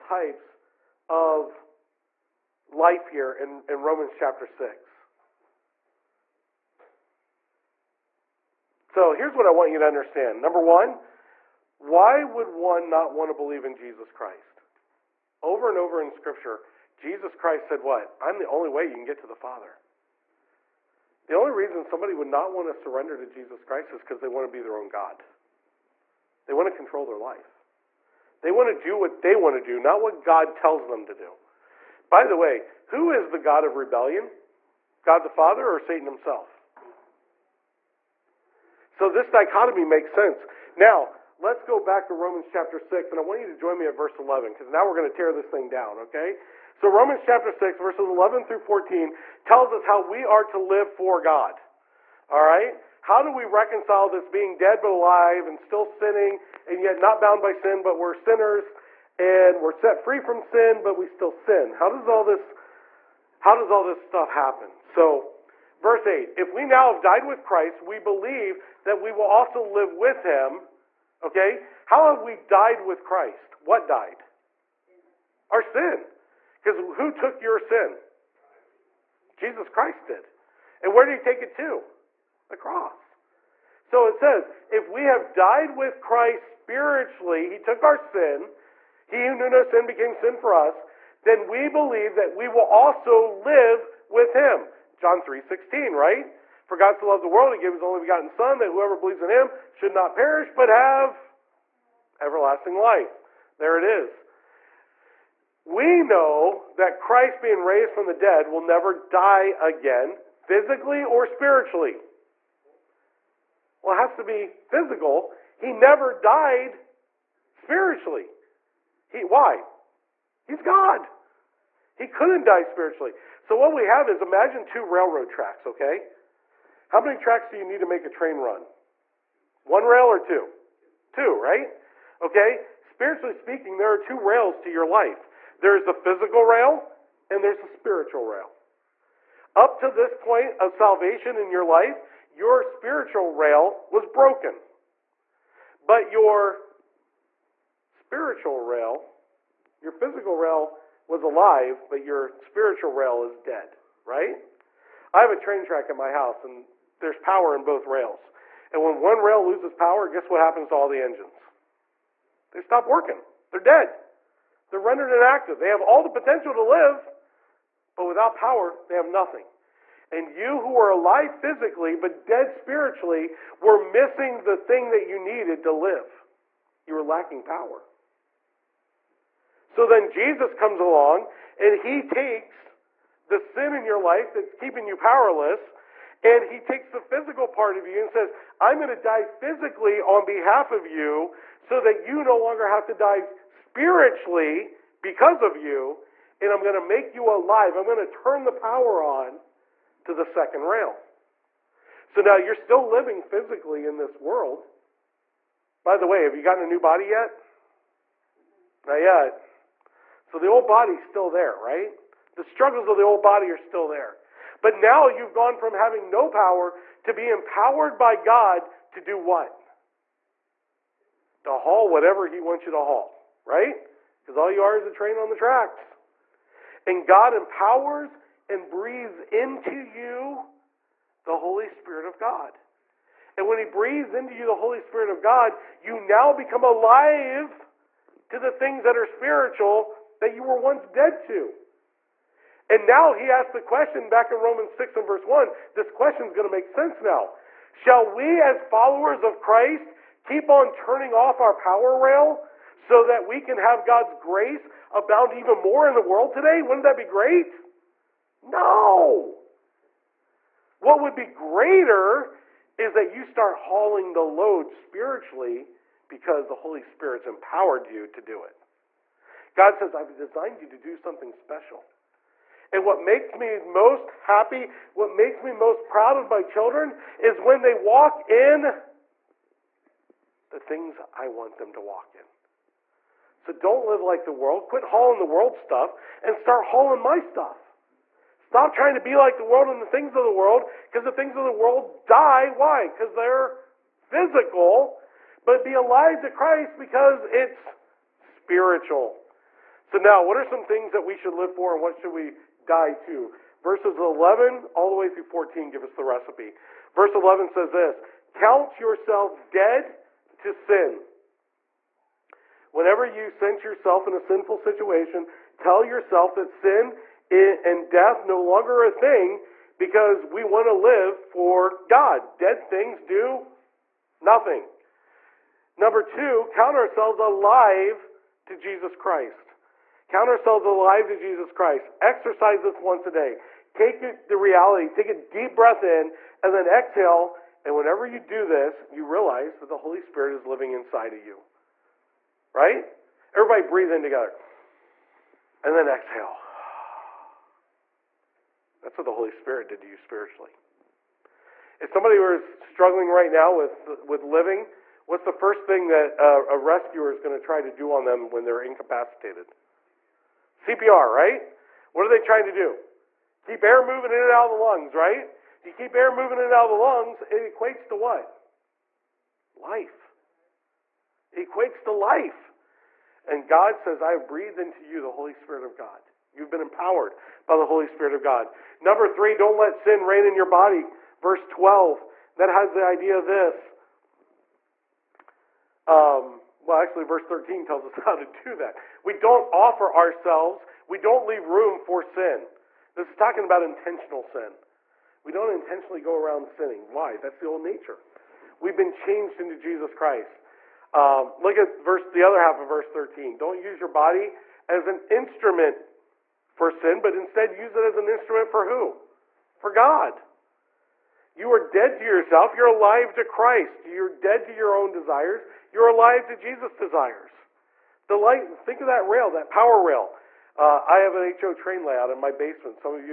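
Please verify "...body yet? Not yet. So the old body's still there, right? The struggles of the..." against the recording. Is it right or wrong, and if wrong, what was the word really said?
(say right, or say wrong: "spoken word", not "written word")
right.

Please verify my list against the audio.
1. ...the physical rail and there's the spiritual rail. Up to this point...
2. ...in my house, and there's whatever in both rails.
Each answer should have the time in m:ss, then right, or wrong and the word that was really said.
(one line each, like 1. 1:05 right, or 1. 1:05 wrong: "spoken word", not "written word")
1. 2:15 right
2. 2:35 wrong: "power", not "whatever".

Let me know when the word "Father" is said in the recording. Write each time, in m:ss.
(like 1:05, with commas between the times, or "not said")
0:19, 0:35.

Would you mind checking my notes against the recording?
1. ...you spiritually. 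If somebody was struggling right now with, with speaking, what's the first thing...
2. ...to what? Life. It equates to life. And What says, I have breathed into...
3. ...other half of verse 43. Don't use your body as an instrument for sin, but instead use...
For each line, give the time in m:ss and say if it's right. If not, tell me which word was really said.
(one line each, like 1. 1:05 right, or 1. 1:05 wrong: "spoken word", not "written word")
1. 5:49 wrong: "living", not "speaking"
2. 6:07 wrong: "God", not "What"
3. 6:42 wrong: "13", not "43".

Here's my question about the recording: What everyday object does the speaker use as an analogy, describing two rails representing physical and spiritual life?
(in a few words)
Railroad tracks.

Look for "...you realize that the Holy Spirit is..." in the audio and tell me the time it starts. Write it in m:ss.
5:38.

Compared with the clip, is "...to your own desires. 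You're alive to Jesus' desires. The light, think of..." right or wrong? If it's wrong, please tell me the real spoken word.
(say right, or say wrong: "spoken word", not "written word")
right.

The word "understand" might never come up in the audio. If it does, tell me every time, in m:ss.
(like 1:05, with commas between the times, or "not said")
0:09.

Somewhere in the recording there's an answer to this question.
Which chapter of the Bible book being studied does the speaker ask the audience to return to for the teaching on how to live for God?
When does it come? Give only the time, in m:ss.
0:46.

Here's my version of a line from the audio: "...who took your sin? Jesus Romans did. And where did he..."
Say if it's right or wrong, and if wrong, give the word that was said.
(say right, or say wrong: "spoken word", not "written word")
wrong: "Christ", not "Romans".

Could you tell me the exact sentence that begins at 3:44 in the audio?
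Because all you are is a train on the tracks.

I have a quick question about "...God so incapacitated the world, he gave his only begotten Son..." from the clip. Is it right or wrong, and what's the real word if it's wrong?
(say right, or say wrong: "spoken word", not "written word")
wrong: "loved", not "incapacitated".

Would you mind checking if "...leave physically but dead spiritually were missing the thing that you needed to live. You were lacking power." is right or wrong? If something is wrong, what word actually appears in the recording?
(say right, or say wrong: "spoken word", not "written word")
wrong: "alive", not "leave".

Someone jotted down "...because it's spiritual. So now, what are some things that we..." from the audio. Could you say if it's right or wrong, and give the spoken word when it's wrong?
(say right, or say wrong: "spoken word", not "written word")
right.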